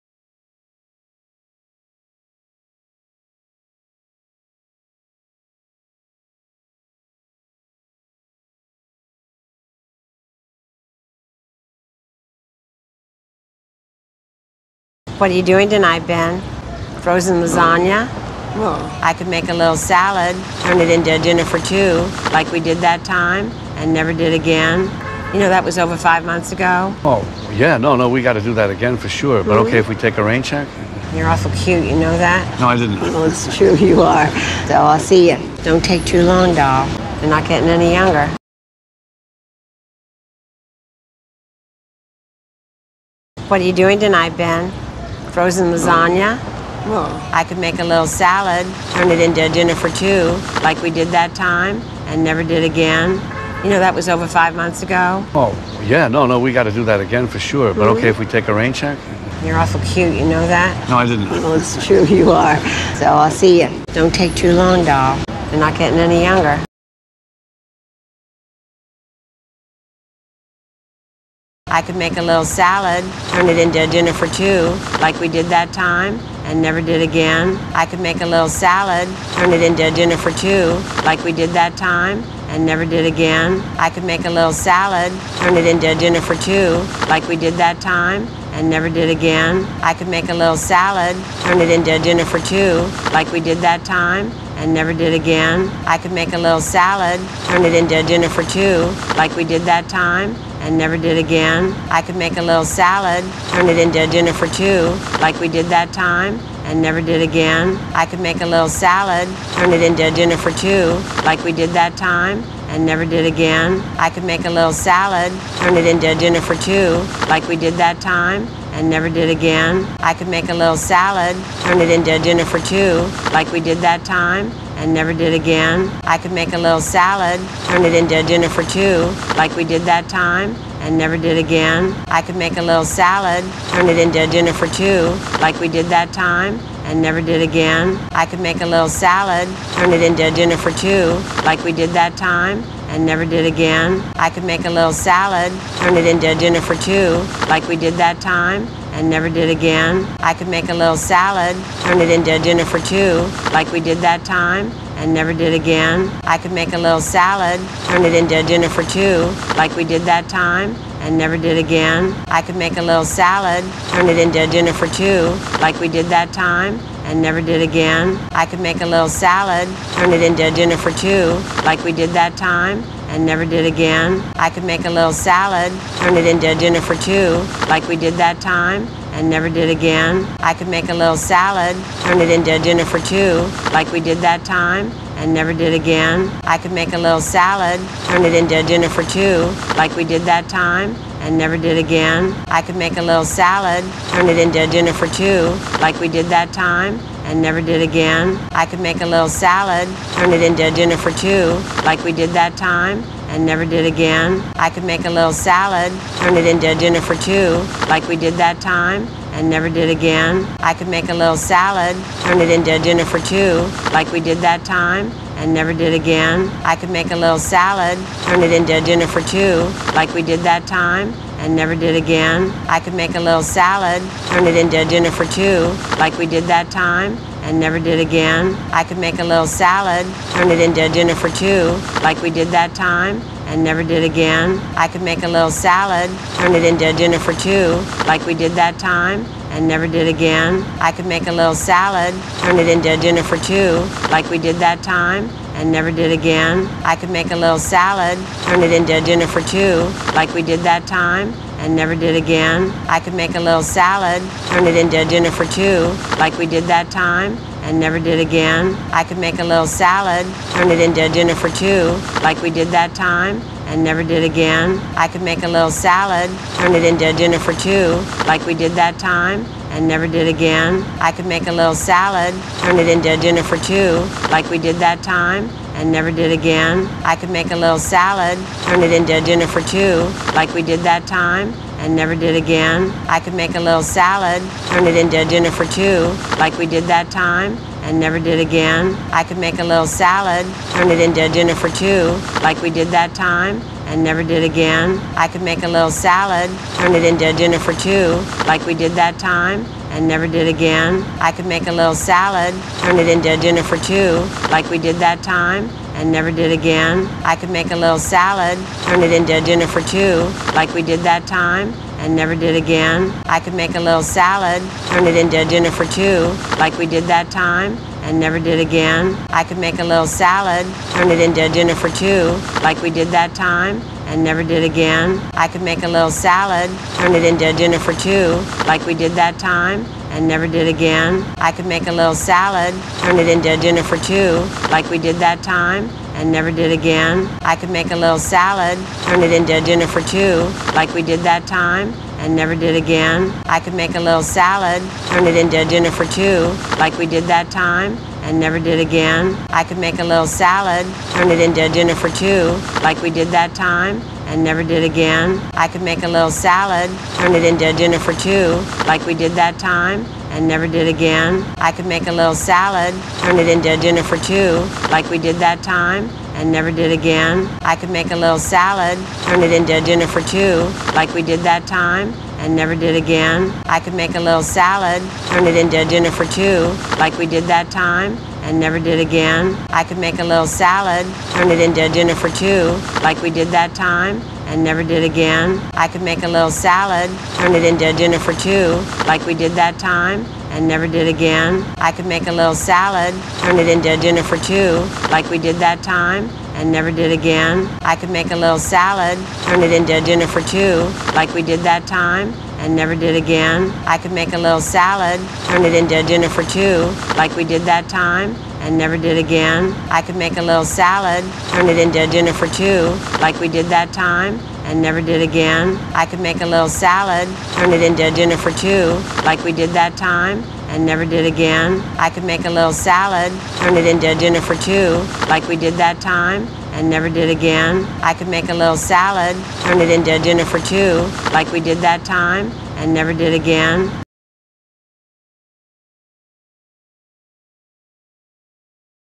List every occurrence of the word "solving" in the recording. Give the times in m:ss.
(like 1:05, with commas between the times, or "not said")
not said.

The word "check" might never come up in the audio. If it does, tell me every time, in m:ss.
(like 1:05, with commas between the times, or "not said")
0:30, 0:58.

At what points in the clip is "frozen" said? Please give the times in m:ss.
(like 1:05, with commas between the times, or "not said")
0:17, 0:45.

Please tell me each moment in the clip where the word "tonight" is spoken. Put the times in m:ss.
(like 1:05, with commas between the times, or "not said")
0:15, 0:43.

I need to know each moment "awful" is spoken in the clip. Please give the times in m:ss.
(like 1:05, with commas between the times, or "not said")
0:31, 0:59.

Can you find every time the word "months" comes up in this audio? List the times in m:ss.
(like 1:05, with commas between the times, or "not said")
0:26, 0:54.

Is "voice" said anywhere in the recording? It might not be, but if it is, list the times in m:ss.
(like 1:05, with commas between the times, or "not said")
not said.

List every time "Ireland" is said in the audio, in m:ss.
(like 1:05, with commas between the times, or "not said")
not said.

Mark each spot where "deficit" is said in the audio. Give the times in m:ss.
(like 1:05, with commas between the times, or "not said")
not said.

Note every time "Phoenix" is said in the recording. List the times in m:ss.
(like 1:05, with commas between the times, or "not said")
not said.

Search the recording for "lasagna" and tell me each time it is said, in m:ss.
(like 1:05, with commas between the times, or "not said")
0:17, 0:45.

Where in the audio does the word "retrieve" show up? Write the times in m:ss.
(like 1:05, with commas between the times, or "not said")
not said.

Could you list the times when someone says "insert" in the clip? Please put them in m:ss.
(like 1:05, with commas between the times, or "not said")
not said.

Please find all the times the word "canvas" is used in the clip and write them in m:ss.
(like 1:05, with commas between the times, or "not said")
not said.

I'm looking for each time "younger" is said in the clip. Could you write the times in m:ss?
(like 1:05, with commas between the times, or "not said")
0:37, 1:06.